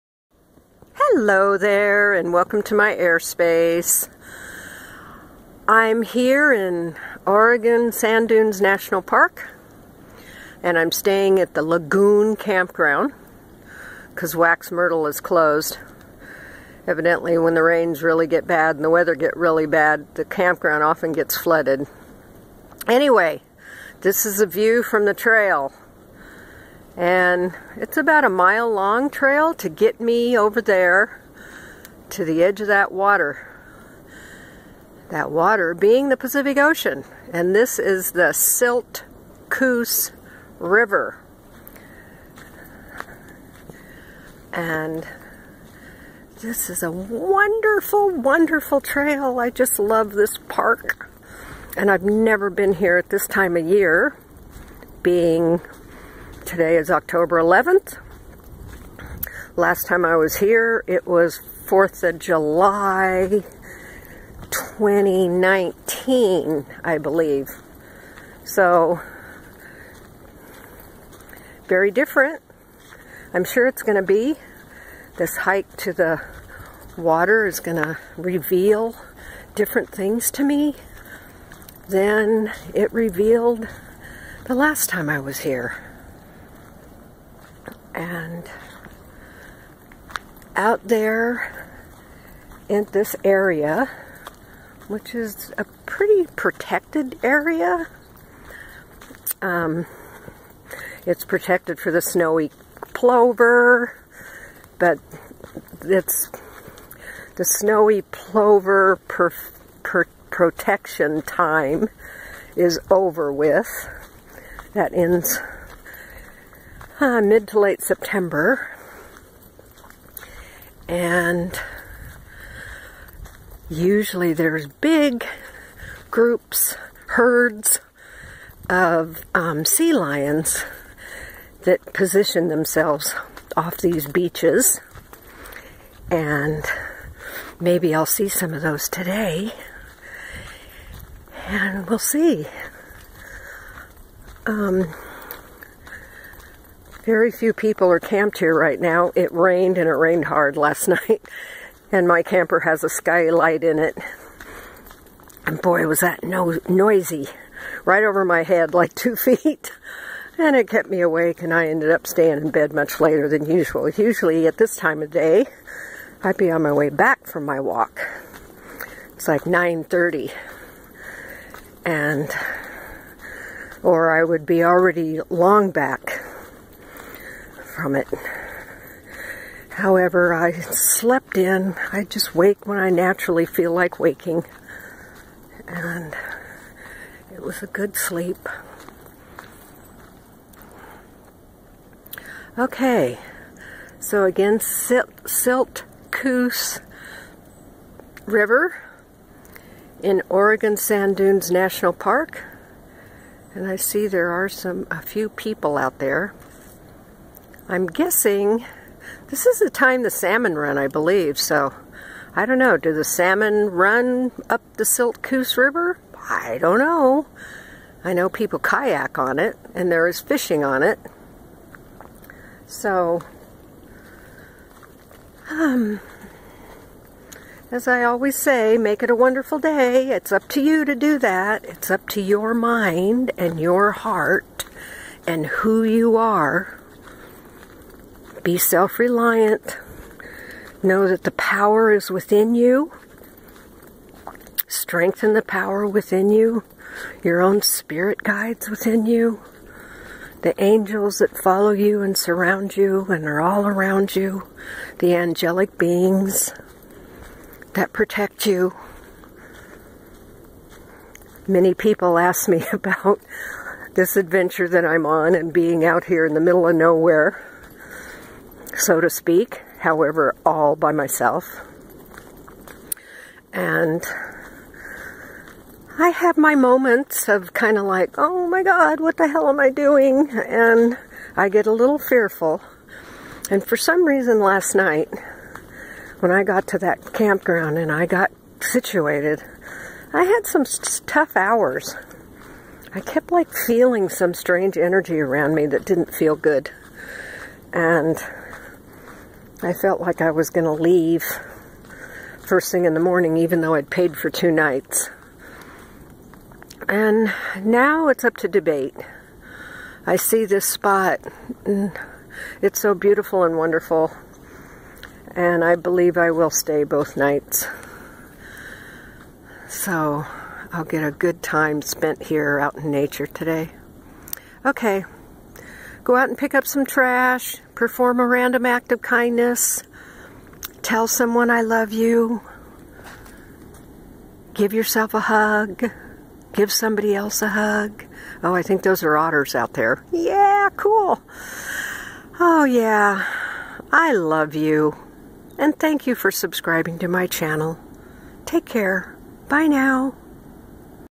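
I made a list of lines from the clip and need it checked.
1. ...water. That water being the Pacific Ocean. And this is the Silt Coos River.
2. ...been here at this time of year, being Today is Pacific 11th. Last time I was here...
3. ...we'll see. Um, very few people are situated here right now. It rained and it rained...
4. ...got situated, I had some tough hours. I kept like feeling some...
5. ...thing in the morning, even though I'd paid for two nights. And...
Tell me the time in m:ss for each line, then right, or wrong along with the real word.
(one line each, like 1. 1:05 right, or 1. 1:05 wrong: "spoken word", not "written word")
1. 0:32 right
2. 0:52 wrong: "October", not "Pacific"
3. 2:21 wrong: "camped", not "situated"
4. 4:48 right
5. 5:02 right.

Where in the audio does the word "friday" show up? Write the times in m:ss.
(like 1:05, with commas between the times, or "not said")
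not said.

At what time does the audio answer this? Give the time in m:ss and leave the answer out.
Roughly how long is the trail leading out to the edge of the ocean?
0:27.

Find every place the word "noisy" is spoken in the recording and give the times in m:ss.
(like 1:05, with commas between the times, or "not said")
2:36.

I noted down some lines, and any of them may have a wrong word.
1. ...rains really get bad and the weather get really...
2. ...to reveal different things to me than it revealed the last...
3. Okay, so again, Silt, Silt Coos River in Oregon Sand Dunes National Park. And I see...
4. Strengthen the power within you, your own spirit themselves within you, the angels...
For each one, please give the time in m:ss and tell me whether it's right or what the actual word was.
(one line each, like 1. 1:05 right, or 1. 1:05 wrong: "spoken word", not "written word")
1. 0:17 right
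2. 1:17 right
3. 3:12 right
4. 4:04 wrong: "guides", not "themselves".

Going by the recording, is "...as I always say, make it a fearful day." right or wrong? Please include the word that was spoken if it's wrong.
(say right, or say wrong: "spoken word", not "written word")
wrong: "wonderful", not "fearful".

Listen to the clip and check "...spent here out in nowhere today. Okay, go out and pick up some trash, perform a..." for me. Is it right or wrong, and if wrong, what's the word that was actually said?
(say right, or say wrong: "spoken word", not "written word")
wrong: "nature", not "nowhere".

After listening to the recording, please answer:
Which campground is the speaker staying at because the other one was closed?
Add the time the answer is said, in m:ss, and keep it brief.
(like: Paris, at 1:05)
Lagoon Campground, at 0:11.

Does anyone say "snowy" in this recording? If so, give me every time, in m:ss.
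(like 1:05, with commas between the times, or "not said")
1:42, 1:47.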